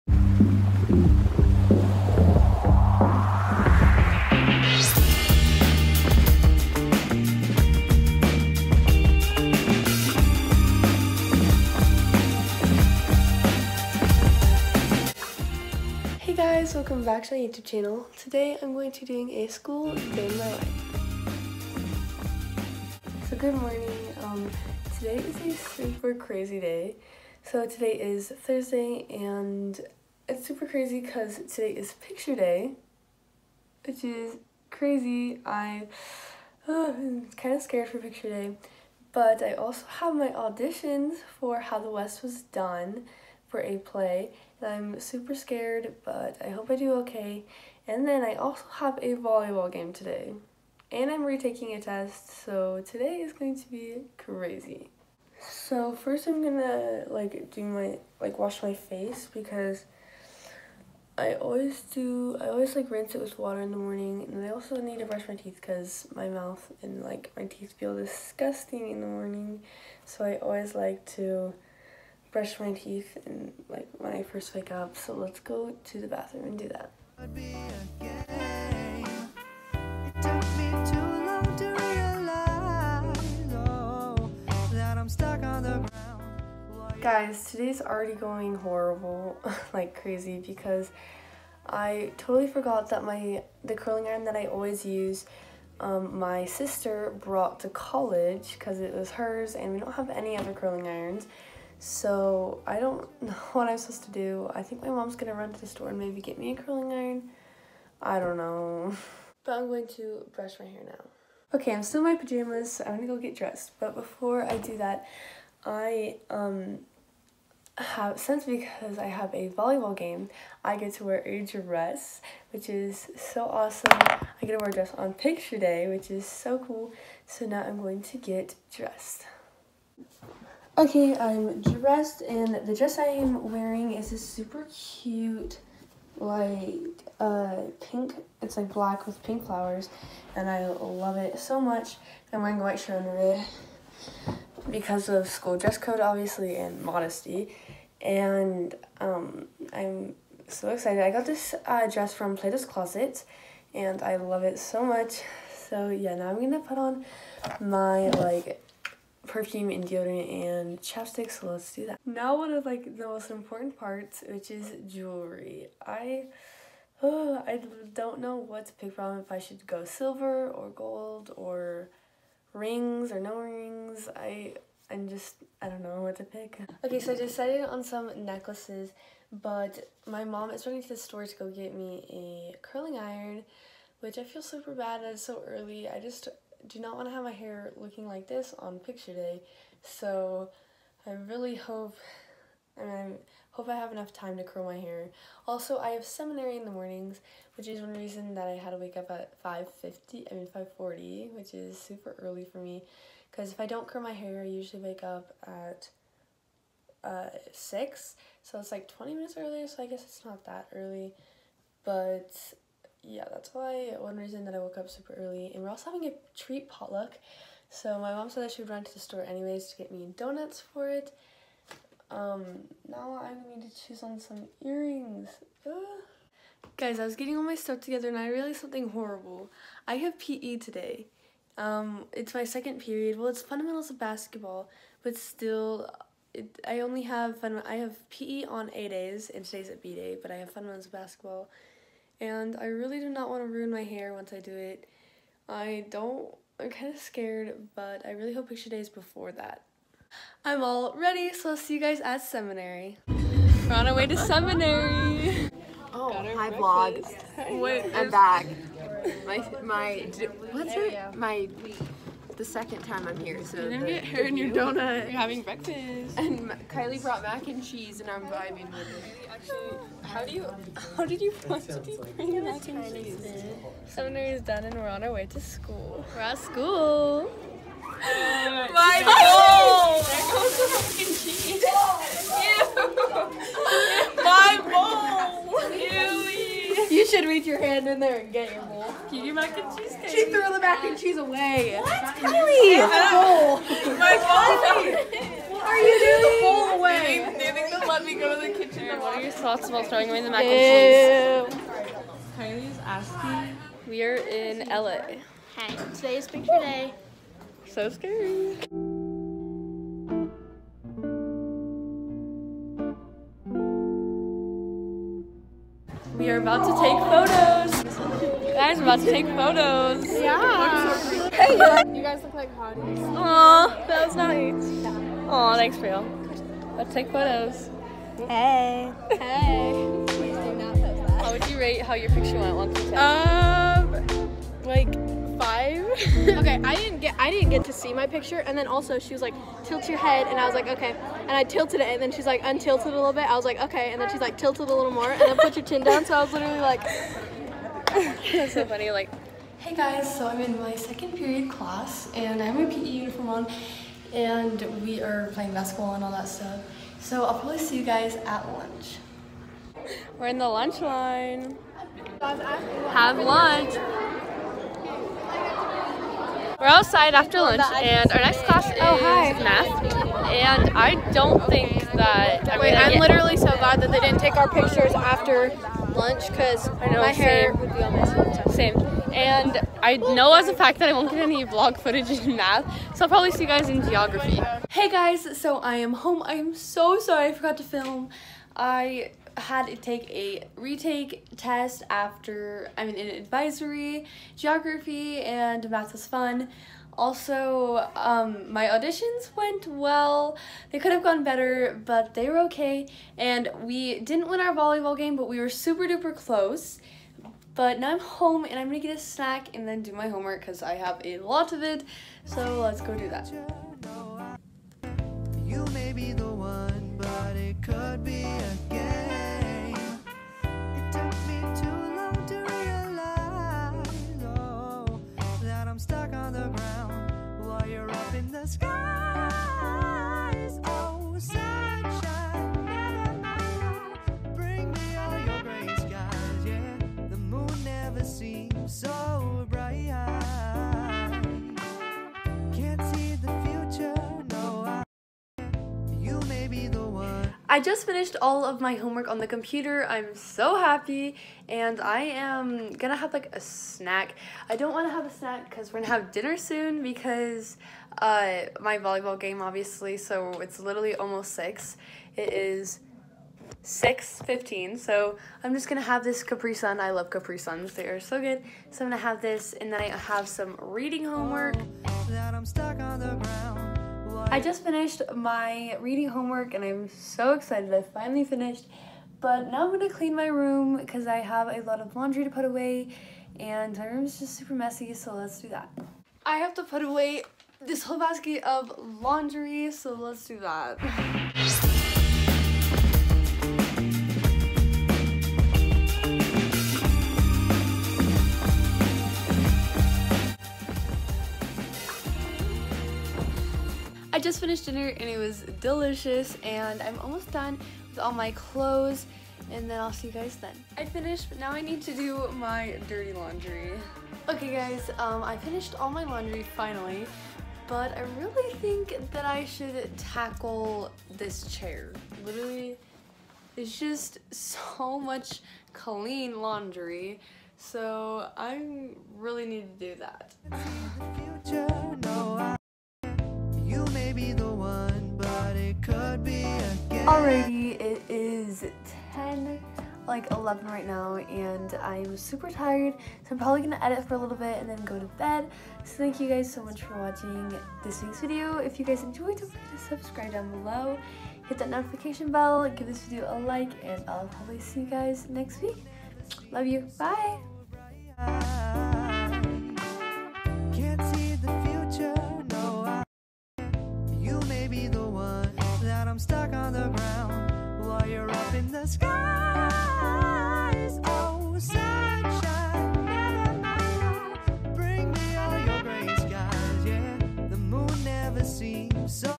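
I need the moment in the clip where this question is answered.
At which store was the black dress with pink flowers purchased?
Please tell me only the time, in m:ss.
2:32.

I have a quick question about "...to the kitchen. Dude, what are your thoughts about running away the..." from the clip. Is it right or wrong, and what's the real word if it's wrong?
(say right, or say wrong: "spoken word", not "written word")
wrong: "throwing", not "running".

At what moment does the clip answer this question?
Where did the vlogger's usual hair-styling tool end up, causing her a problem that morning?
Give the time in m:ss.
1:37.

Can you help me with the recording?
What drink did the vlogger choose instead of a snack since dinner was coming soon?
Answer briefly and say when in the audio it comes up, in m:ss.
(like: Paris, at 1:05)
Capri Sun, at 7:46.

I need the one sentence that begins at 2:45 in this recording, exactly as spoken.
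I oh, I don't know what to pick from if I should go silver or gold or rings or no rings.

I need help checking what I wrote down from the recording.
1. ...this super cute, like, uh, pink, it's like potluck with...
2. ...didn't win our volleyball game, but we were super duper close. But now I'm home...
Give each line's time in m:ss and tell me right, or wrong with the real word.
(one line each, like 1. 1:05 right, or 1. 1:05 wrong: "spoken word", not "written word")
1. 2:14 wrong: "black", not "potluck"
2. 6:44 right.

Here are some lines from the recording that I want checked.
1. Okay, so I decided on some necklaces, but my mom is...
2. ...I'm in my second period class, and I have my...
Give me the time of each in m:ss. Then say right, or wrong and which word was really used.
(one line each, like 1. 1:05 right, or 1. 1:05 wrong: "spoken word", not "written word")
1. 2:56 right
2. 5:50 right.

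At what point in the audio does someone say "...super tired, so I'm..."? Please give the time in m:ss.
9:02.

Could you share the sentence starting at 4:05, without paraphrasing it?
I don't, I'm kind of scared, but I really hope picture days before that.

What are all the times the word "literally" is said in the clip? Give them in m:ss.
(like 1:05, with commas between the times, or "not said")
5:46, 6:12, 7:40, 8:42.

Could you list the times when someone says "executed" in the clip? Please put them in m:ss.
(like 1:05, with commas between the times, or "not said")
not said.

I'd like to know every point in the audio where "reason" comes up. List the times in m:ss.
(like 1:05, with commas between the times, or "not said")
3:17, 3:34.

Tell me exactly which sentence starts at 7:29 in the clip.
I'm so happy and I am gonna have like a snack.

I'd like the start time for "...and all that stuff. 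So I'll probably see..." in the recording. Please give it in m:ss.
5:55.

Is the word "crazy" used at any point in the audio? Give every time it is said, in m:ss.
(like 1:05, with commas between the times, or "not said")
0:26, 0:30, 0:34, 0:54, 1:29.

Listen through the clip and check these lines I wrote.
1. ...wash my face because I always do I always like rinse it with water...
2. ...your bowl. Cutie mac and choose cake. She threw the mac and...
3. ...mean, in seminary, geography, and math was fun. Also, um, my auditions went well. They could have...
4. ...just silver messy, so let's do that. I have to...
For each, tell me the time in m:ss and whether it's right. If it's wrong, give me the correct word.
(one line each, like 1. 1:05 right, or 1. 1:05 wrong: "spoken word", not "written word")
1. 0:58 right
2. 4:48 wrong: "cheese", not "choose"
3. 6:32 wrong: "advisory", not "seminary"
4. 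8:04 wrong: "super", not "silver".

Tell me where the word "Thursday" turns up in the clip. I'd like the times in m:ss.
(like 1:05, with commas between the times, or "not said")
0:28.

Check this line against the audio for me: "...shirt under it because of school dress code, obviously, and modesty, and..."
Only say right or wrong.
right.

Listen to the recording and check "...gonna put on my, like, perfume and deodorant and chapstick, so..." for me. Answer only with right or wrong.
right.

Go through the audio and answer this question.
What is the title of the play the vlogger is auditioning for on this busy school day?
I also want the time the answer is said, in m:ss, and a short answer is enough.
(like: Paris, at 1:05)
How the West Was Done, at 0:41.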